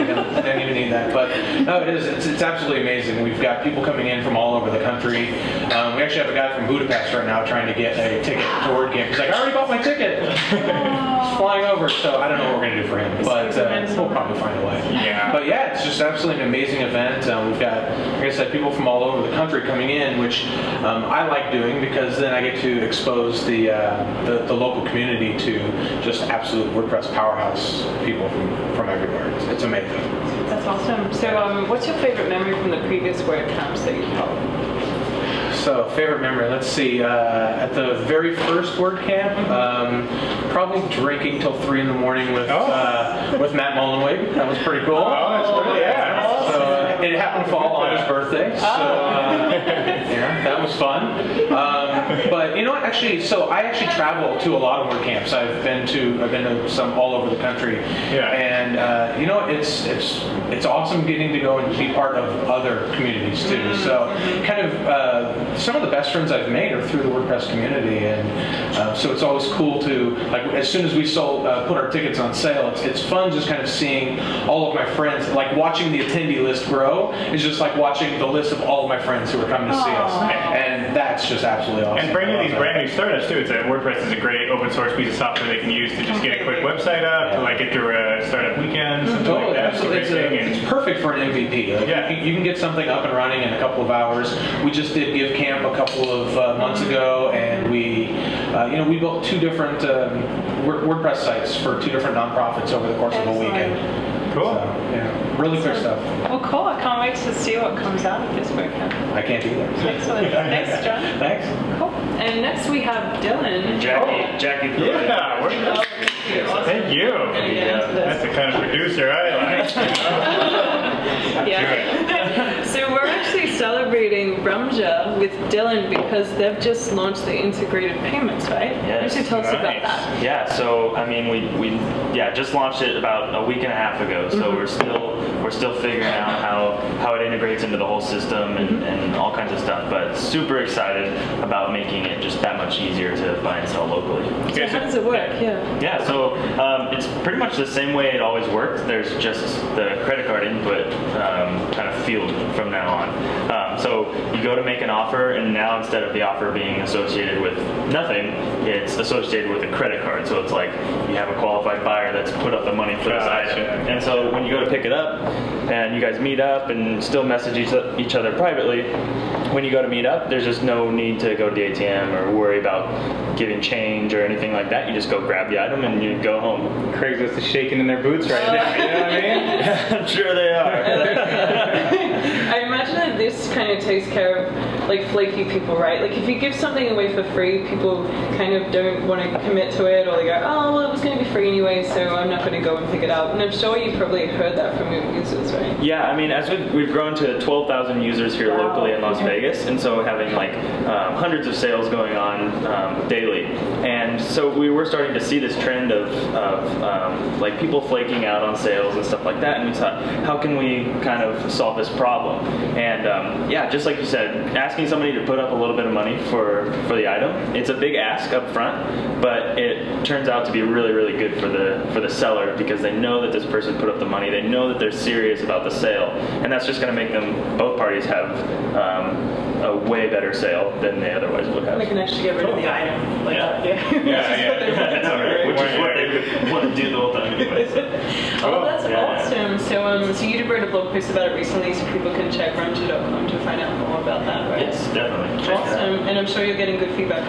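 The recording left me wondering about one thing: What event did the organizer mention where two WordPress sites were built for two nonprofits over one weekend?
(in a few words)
Give Camp.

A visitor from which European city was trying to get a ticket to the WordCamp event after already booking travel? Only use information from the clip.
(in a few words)
Budapest.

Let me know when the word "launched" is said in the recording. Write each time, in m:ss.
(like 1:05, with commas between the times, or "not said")
2:06, 2:12.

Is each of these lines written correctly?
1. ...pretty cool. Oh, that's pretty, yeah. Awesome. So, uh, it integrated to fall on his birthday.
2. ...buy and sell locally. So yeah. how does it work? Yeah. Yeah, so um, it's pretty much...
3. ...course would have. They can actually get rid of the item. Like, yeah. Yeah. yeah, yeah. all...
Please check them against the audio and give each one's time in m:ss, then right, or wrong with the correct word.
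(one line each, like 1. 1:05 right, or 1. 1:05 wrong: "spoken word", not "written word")
1. 0:44 wrong: "happened", not "integrated"
2. 2:23 right
3. 3:51 wrong: "otherwise", not "course".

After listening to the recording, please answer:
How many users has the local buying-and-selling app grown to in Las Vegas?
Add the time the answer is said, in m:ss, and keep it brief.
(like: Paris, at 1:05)
12,000, at 3:17.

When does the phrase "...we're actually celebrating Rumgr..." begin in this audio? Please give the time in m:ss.
2:02.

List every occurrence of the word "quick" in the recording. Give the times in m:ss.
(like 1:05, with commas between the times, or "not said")
1:26, 1:45.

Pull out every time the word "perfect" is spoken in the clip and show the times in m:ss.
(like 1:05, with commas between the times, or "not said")
1:30.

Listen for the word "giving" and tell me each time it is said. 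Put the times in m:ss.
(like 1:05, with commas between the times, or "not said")
2:53.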